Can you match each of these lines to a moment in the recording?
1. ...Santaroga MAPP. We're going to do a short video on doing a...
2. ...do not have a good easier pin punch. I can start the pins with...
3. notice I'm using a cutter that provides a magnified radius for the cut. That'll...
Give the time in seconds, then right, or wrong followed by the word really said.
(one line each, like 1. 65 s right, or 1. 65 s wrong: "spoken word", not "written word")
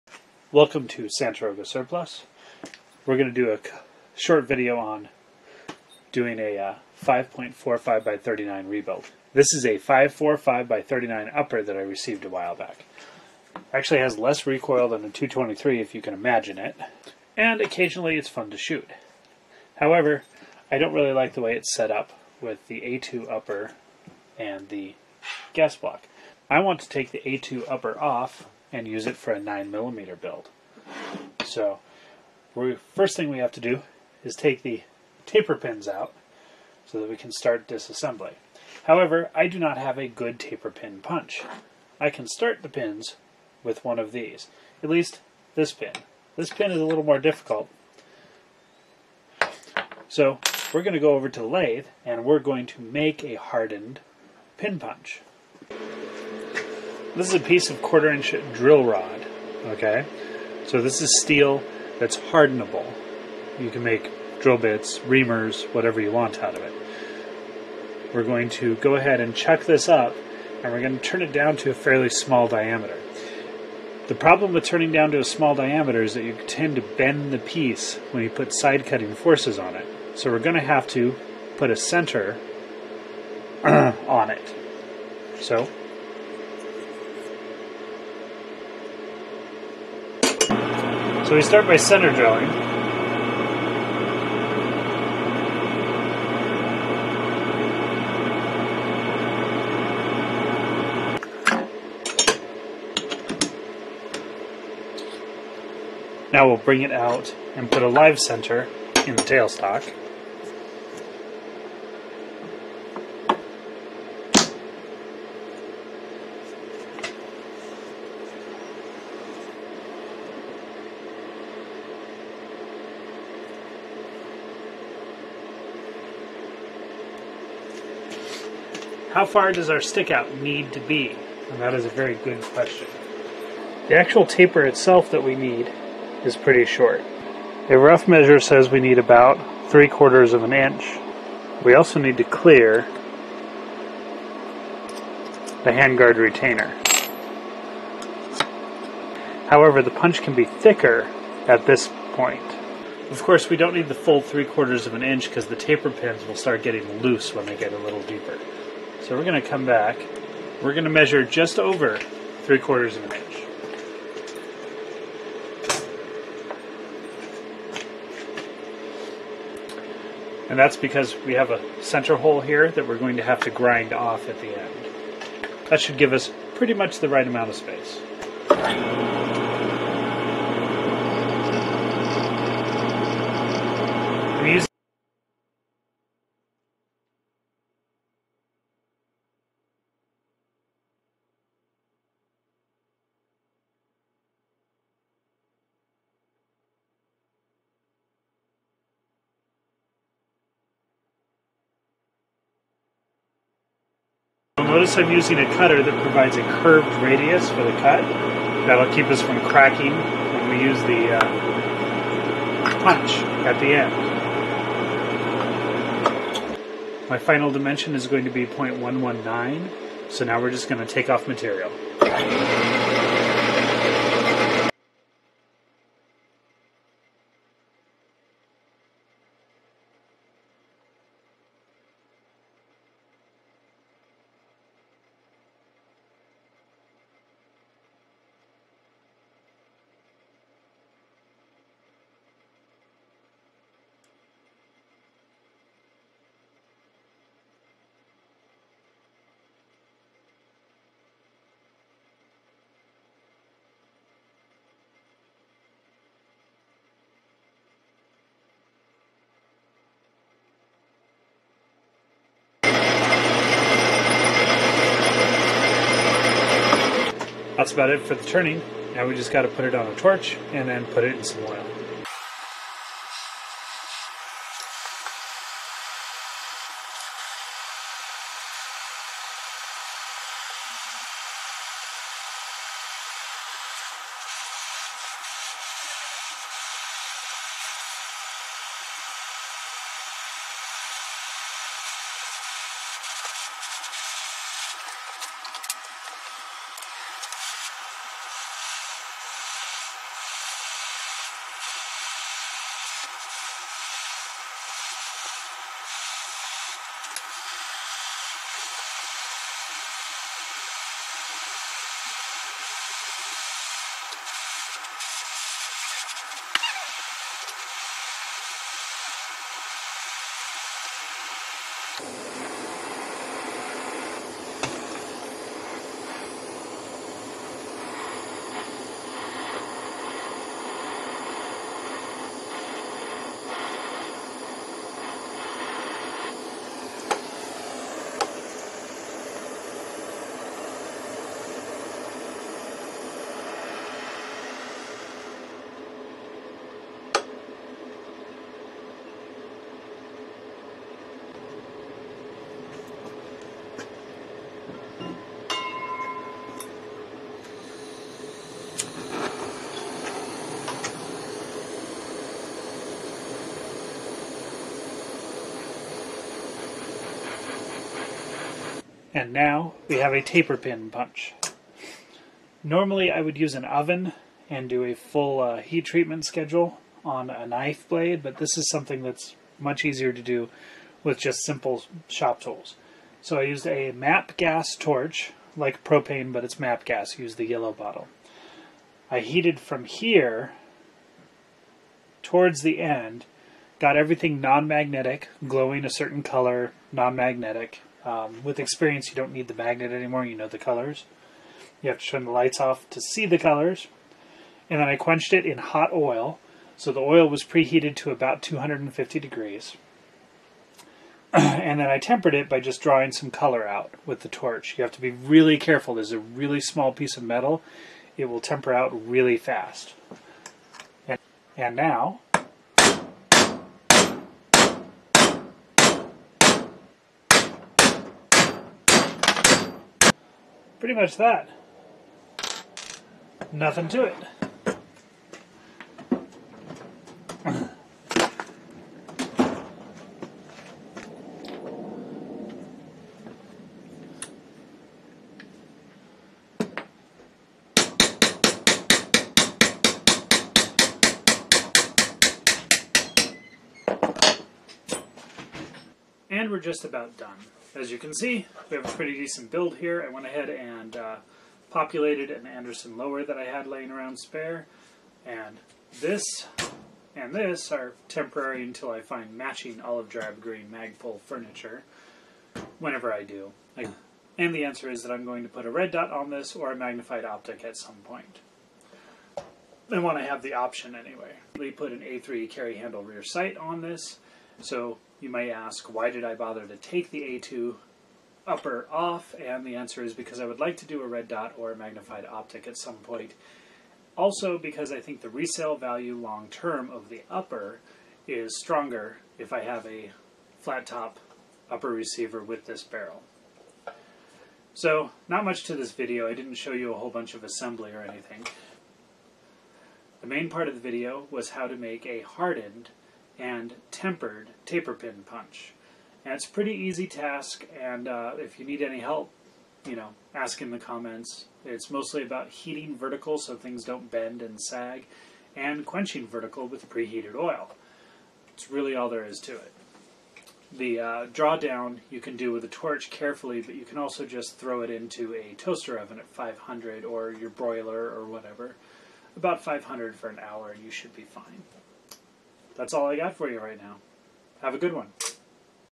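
1. 1 s wrong: "Surplus", not "MAPP"
2. 39 s wrong: "taper", not "easier"
3. 204 s wrong: "curved", not "magnified".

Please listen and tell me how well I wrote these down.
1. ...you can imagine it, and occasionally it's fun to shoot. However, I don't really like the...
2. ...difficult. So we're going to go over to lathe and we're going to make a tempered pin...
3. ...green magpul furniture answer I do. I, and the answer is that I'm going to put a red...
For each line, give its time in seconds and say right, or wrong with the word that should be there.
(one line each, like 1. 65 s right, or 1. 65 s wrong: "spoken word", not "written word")
1. 15 s right
2. 47 s wrong: "hardened", not "tempered"
3. 470 s wrong: "whenever", not "answer".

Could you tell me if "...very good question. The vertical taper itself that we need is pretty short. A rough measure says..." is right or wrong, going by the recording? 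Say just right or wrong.
wrong.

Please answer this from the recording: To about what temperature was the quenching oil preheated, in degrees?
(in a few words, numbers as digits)
250.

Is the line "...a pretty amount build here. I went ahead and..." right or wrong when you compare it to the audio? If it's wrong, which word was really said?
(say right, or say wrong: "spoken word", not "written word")
wrong: "decent", not "amount".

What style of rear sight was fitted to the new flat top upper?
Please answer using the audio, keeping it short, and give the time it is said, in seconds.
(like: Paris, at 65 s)
A3 carry handle, at 481 s.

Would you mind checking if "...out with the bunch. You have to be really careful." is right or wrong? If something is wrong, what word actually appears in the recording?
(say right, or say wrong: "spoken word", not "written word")
wrong: "torch", not "bunch".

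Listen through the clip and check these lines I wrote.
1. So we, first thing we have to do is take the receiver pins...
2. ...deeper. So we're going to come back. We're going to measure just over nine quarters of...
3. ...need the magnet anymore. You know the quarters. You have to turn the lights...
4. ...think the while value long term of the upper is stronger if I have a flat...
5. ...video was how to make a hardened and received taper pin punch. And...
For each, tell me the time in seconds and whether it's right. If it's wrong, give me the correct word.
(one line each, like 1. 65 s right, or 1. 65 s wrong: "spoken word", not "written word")
1. 31 s wrong: "taper", not "receiver"
2. 158 s wrong: "three", not "nine"
3. 399 s wrong: "colors", not "quarters"
4. 494 s wrong: "resale", not "while"
5. 510 s wrong: "tempered", not "received".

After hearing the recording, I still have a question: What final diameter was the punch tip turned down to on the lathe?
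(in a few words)
0.119.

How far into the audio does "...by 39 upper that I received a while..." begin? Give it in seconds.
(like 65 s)
10 s.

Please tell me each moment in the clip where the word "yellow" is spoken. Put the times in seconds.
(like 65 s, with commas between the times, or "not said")
387 s.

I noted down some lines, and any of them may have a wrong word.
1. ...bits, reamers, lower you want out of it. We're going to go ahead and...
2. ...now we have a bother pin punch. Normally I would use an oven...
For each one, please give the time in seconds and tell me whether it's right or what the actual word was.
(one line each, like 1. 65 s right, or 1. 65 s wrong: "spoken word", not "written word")
1. 64 s wrong: "whatever", not "lower"
2. 369 s wrong: "taper", not "bother".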